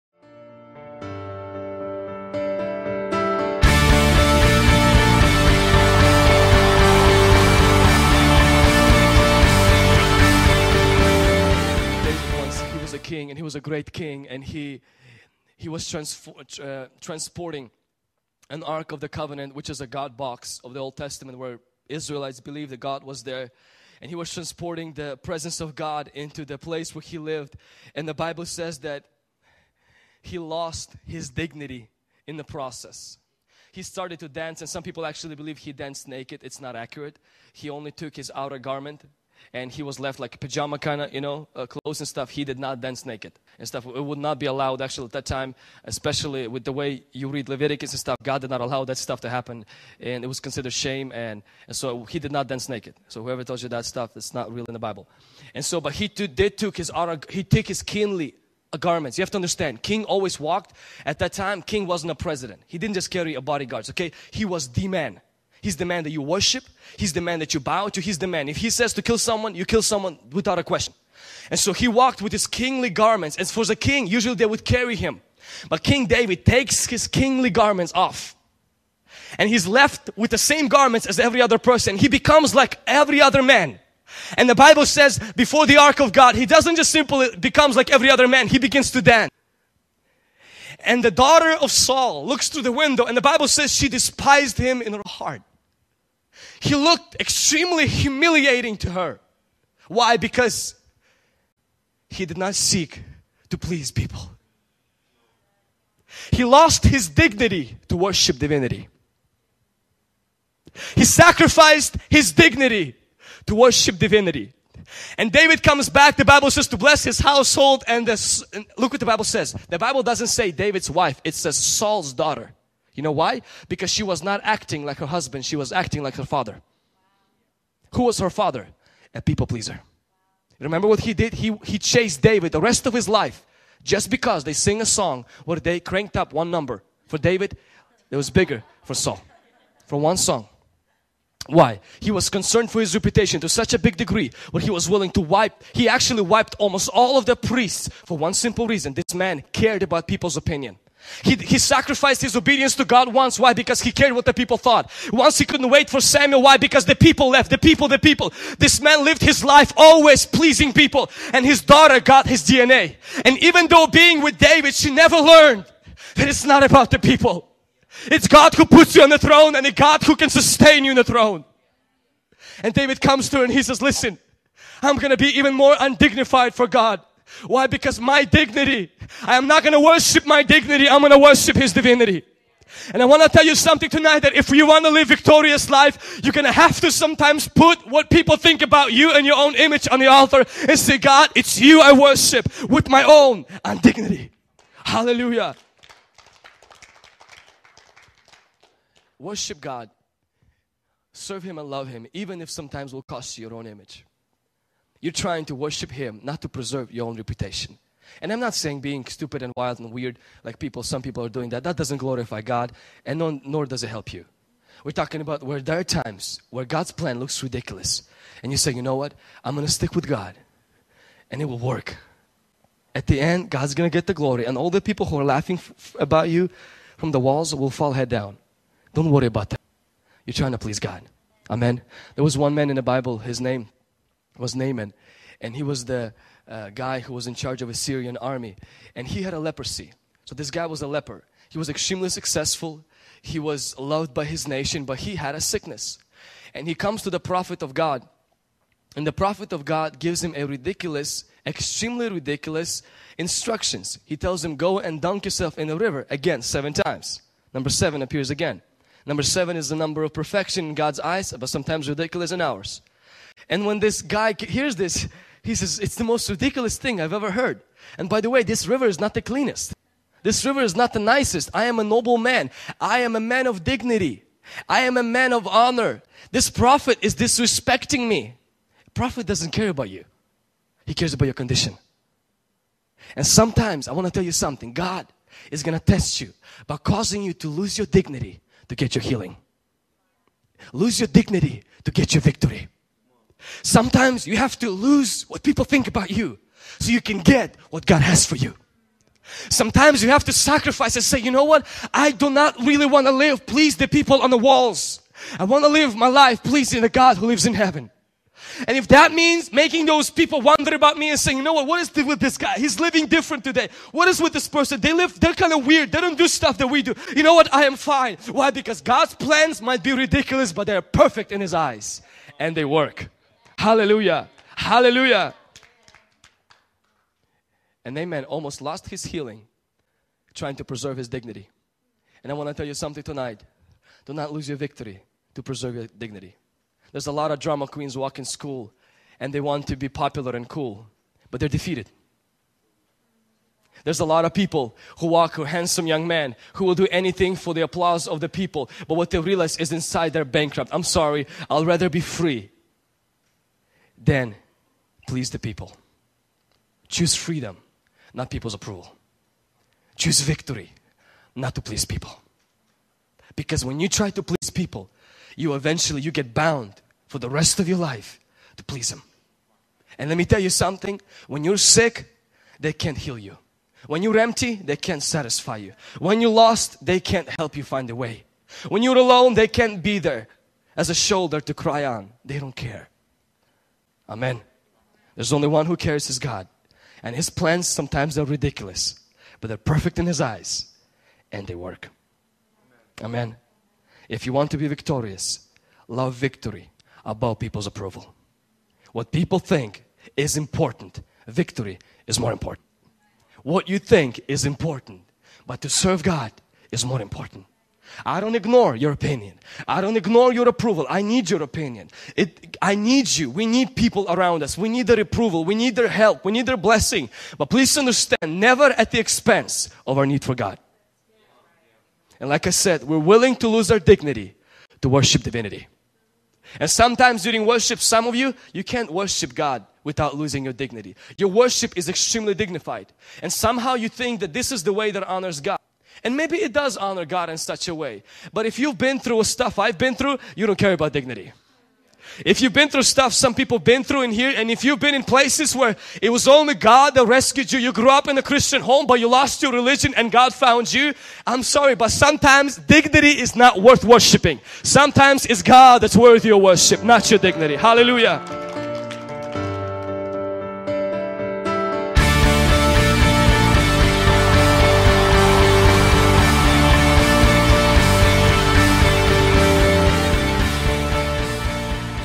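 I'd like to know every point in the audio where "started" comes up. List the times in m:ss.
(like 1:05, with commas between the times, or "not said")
0:33.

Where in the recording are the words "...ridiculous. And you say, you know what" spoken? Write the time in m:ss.
3:37.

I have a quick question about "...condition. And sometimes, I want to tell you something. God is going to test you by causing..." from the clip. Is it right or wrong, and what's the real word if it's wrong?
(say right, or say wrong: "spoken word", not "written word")
right.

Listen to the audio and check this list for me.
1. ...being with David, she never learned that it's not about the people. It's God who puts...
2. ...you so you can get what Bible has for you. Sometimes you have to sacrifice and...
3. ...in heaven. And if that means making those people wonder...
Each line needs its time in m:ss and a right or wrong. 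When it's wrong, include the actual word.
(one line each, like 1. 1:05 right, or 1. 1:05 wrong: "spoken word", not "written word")
1. 2:43 right
2. 4:56 wrong: "God", not "Bible"
3. 5:07 right.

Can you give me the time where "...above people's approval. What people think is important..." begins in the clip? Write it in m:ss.
6:37.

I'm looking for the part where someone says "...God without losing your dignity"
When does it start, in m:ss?
7:09.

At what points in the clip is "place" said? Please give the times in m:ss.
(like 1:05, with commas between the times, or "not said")
0:26, 7:25.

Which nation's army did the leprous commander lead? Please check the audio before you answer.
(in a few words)
Syrian.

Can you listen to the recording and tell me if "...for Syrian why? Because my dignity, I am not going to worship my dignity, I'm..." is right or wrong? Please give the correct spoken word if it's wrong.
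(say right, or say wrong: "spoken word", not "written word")
wrong: "God", not "Syrian".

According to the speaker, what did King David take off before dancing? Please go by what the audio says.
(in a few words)
His outer garment.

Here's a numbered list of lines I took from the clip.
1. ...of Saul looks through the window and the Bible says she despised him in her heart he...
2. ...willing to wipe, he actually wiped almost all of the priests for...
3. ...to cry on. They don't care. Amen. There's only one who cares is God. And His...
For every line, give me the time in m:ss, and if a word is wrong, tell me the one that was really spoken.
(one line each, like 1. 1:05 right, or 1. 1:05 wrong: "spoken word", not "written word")
1. 1:31 right
2. 2:24 right
3. 6:21 right.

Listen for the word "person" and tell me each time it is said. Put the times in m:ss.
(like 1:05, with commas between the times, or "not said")
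1:21, 5:14.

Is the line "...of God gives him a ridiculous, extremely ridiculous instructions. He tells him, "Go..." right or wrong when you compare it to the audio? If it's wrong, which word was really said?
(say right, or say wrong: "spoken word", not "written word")
right.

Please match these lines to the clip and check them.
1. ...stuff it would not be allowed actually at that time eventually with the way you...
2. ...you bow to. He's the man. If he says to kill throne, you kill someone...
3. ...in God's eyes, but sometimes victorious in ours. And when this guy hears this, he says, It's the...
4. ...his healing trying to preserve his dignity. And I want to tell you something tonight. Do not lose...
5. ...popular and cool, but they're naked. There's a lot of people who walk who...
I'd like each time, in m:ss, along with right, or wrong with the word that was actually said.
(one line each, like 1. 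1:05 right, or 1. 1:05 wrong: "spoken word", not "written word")
1. 0:43 wrong: "especially", not "eventually"
2. 1:07 wrong: "someone", not "throne"
3. 4:20 wrong: "ridiculous", not "victorious"
4. 5:28 right
5. 5:39 wrong: "defeated", not "naked".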